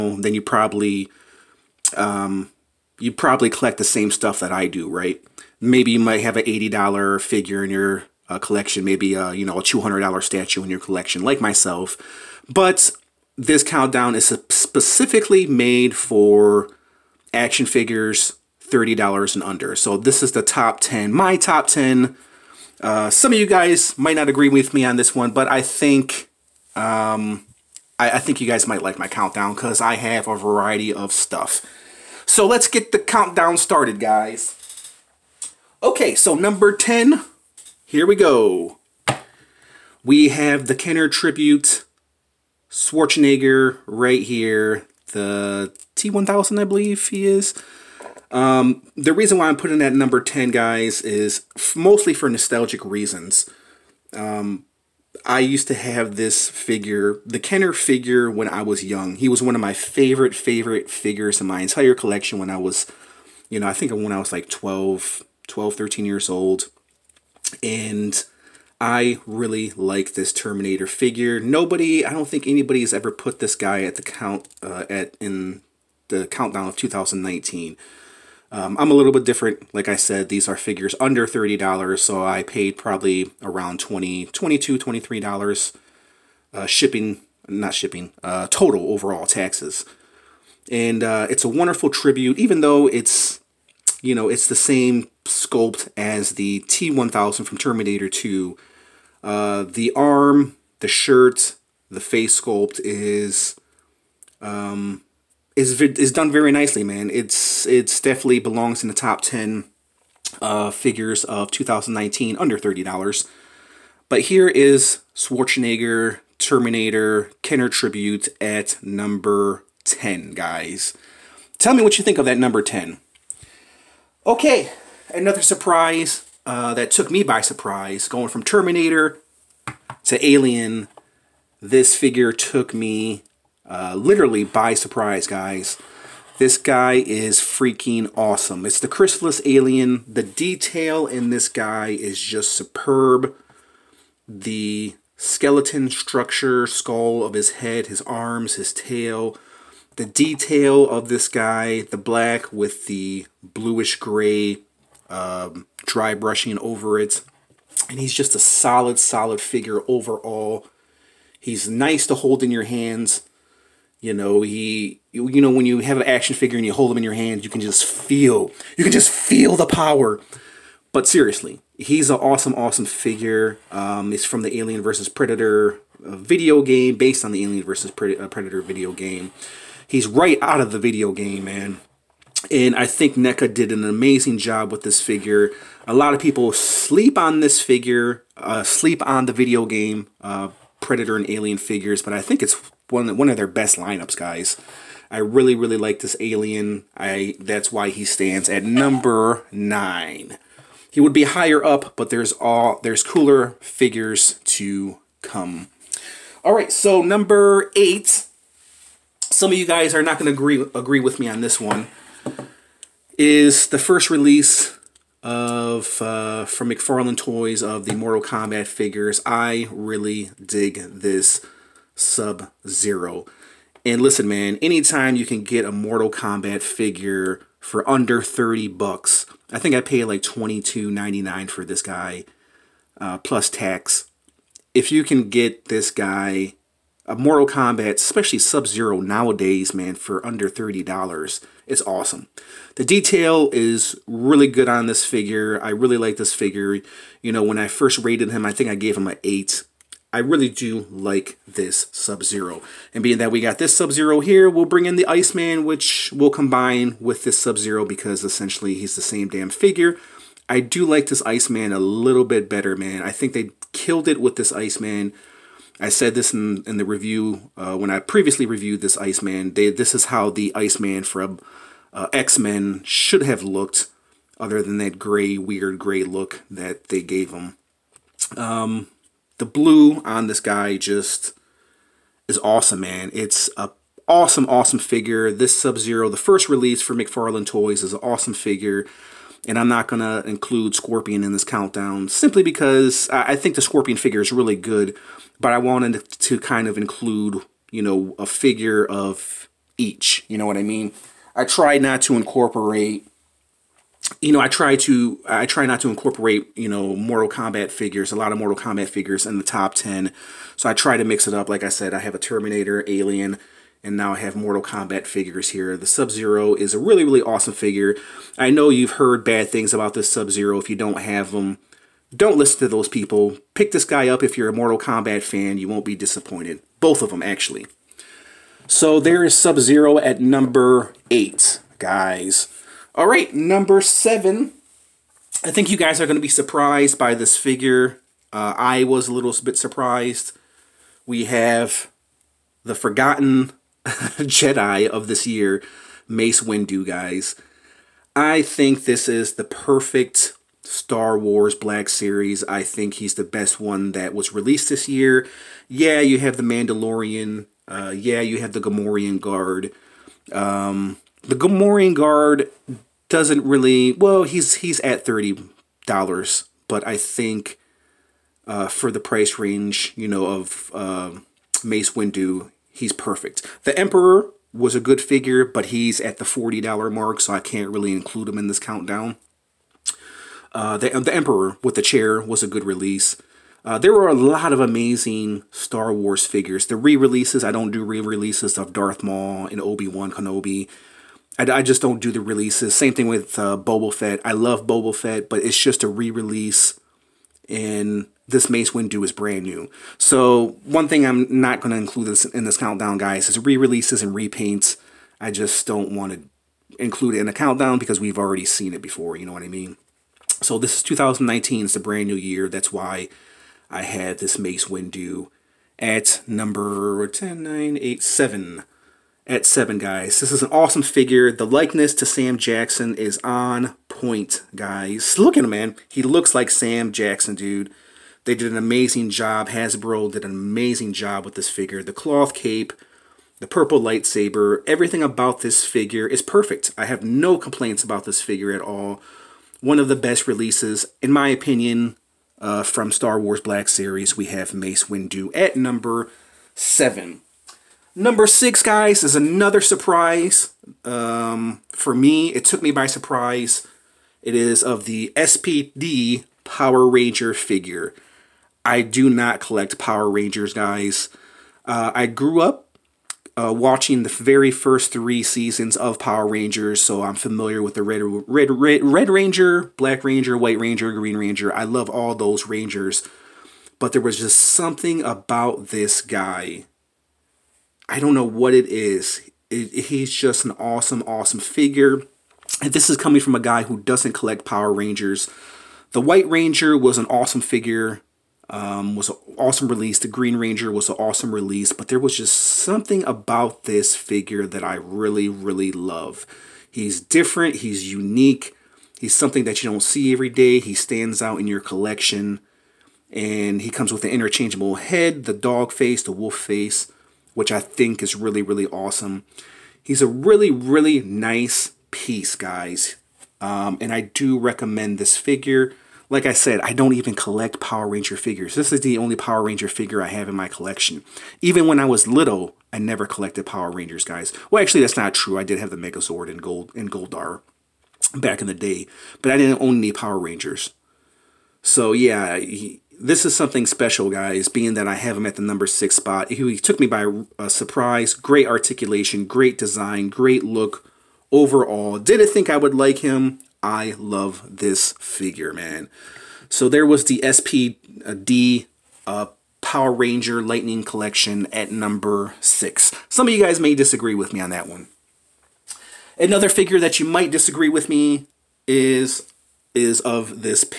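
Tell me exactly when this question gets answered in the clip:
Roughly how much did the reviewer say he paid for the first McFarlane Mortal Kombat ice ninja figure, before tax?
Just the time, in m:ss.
3:50.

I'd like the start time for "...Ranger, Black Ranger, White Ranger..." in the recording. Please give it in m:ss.
7:49.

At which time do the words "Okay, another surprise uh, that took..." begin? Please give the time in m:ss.
2:04.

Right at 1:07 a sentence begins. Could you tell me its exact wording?
And I really like this Terminator figure.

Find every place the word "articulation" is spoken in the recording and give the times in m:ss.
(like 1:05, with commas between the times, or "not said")
8:58.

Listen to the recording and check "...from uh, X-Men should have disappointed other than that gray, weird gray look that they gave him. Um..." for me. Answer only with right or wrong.
wrong.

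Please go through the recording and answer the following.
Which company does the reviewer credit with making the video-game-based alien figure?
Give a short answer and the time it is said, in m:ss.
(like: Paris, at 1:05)
NECA, at 3:03.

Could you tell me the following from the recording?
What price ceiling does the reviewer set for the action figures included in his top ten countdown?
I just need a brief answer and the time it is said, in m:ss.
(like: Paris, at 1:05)
$30, at 0:18.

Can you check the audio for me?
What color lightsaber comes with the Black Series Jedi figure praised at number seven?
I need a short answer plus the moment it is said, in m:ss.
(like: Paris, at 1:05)
Purple, at 7:13.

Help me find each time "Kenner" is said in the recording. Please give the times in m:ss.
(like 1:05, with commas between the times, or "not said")
0:40, 0:57, 1:57.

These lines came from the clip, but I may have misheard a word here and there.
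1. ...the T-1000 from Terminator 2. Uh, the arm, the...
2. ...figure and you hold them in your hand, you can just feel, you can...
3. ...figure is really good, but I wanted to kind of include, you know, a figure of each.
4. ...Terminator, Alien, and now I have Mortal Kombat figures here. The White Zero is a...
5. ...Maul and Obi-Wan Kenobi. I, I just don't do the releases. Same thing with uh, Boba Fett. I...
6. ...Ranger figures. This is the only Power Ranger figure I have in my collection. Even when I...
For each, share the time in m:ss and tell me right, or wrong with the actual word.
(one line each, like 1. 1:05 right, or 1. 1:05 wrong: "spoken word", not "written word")
1. 1:36 right
2. 2:46 right
3. 4:53 right
4. 5:12 wrong: "Sub", not "White"
5. 6:29 right
6. 8:37 right.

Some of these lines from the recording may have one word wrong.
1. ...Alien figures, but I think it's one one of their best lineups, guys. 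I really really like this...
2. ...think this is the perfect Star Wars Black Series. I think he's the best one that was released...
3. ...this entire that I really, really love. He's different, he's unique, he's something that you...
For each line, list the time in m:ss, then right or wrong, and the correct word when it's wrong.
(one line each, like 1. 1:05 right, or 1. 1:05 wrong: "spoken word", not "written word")
1. 3:11 right
2. 5:48 right
3. 8:13 wrong: "figure", not "entire".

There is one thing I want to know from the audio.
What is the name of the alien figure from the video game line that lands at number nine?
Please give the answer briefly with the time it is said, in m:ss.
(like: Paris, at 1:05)
Chrysalis Alien, at 2:18.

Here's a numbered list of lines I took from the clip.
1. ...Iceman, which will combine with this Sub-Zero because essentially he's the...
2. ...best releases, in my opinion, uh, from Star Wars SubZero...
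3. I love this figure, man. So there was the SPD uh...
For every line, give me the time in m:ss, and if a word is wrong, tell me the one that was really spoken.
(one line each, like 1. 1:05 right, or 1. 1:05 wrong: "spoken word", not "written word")
1. 4:15 right
2. 7:19 wrong: "Black", not "SubZero"
3. 9:03 right.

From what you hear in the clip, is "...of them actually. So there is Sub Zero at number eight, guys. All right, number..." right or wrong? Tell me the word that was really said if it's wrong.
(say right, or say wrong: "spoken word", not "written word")
right.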